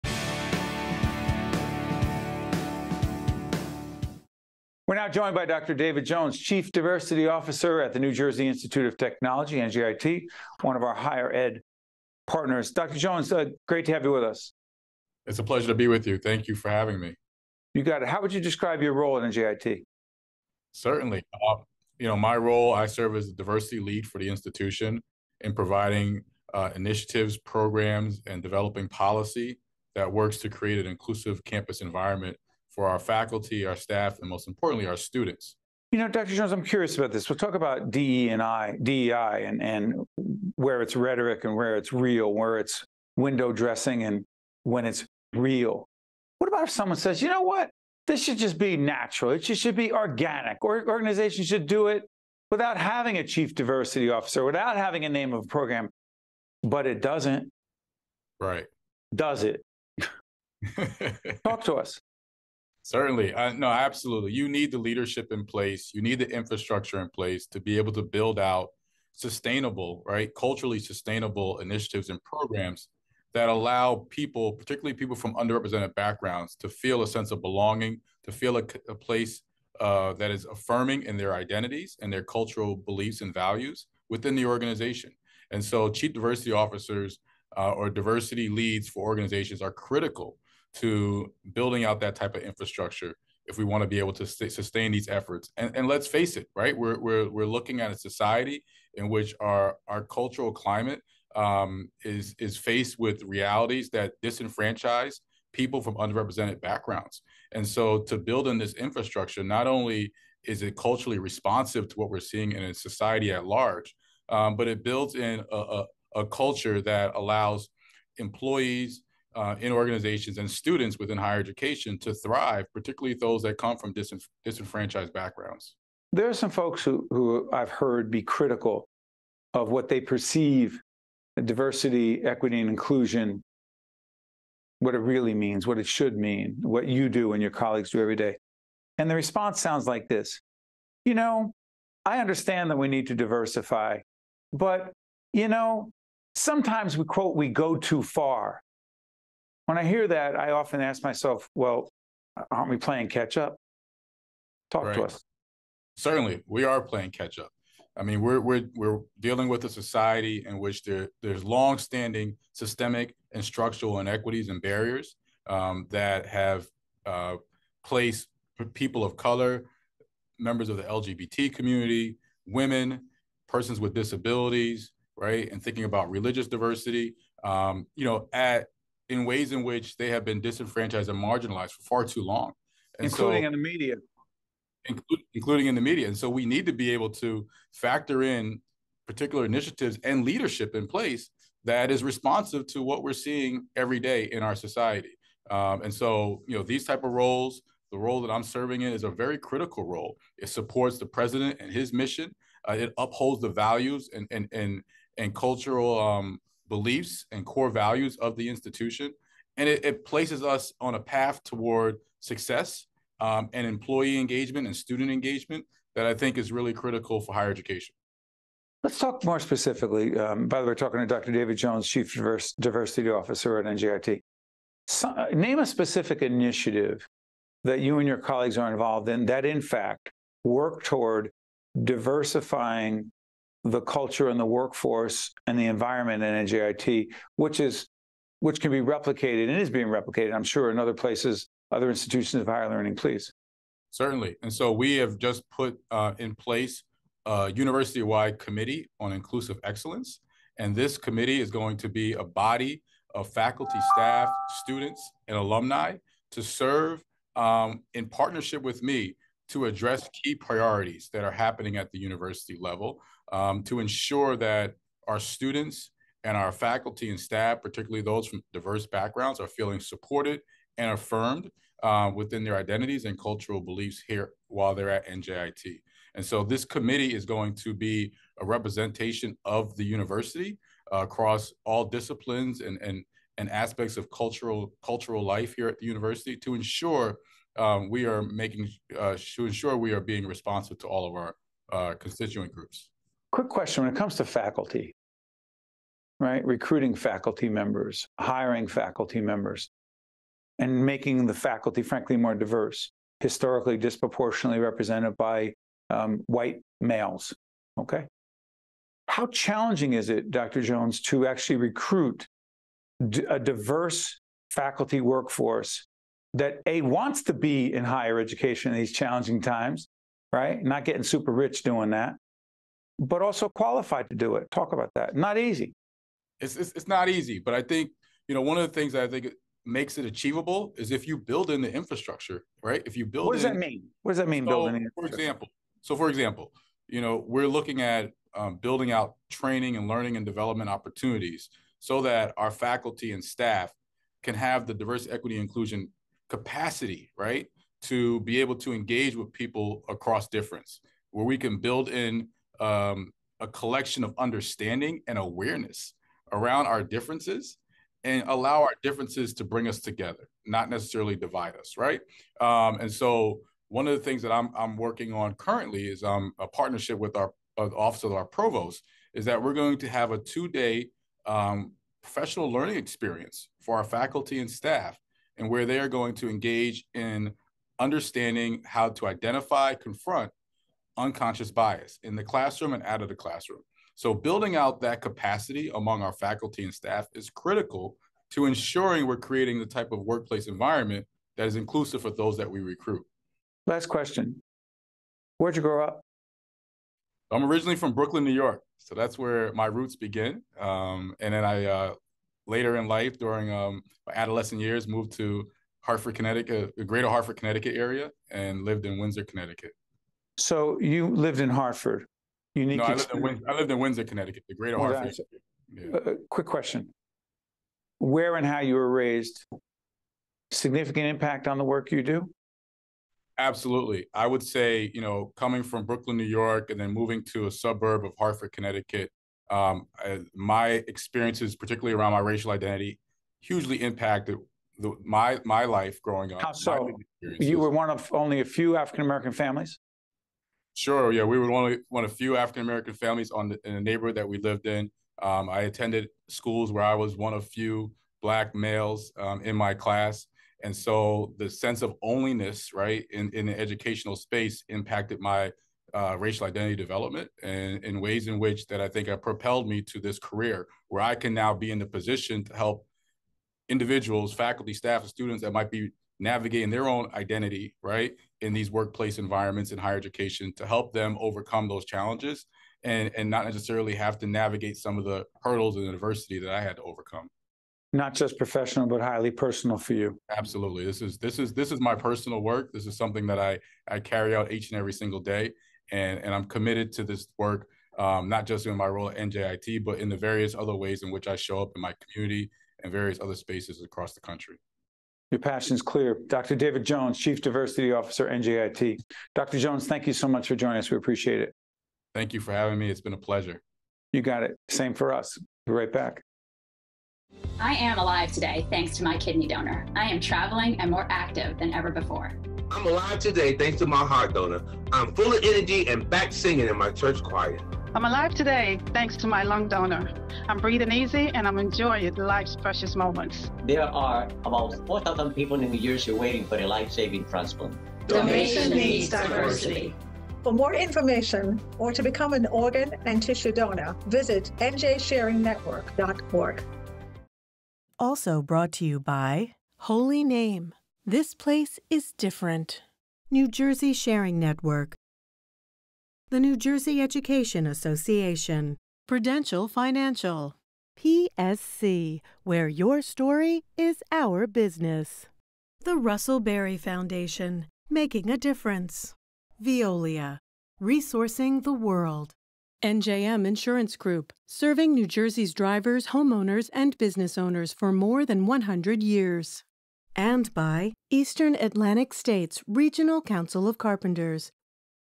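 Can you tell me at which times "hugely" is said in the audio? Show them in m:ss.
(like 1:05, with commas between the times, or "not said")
7:13.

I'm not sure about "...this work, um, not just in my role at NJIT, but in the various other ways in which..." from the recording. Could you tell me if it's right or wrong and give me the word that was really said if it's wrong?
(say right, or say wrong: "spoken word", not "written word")
right.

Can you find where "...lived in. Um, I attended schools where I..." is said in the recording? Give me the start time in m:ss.
7:24.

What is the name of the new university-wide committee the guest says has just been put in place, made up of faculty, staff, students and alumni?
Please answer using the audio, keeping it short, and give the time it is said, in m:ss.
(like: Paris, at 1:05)
Committee on inclusive excellence, at 4:08.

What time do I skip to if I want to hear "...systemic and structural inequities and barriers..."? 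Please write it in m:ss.
2:42.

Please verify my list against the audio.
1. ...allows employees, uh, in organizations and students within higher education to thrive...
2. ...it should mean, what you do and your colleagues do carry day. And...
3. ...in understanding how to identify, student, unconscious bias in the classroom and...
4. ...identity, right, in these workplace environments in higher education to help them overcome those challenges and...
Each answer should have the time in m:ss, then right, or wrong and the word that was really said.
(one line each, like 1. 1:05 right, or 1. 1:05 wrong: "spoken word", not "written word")
1. 1:57 right
2. 2:15 wrong: "every", not "carry"
3. 6:16 wrong: "confront", not "student"
4. 7:47 right.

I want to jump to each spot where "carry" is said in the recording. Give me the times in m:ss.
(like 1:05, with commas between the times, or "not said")
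8:03.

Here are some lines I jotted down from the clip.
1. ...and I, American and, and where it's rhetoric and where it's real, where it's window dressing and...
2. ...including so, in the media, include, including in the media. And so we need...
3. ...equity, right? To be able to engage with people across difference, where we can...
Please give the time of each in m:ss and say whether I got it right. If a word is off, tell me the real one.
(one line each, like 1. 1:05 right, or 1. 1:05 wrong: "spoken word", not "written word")
1. 0:38 wrong: "DEI", not "American"
2. 3:03 right
3. 5:46 wrong: "capacity", not "equity".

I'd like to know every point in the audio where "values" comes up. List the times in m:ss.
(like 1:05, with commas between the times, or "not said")
1:23, 3:23, 3:27.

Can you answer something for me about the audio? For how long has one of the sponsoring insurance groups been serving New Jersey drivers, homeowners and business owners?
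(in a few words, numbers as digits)
More than 100 years.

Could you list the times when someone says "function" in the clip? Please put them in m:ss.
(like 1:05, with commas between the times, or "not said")
not said.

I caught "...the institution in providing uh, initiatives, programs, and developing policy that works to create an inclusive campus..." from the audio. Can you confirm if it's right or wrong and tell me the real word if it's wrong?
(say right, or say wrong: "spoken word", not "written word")
right.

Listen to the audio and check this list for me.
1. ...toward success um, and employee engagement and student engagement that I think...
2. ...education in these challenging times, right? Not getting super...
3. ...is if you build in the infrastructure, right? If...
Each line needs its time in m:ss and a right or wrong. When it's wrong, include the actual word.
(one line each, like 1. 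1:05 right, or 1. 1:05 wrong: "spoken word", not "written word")
1. 3:31 right
2. 5:18 right
3. 5:30 right.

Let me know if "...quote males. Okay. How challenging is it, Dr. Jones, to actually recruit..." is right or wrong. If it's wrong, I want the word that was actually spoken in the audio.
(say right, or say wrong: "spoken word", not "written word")
wrong: "white", not "quote".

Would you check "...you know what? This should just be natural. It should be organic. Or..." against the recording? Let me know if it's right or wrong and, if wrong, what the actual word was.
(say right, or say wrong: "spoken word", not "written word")
right.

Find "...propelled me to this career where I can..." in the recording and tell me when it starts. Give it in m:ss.
7:39.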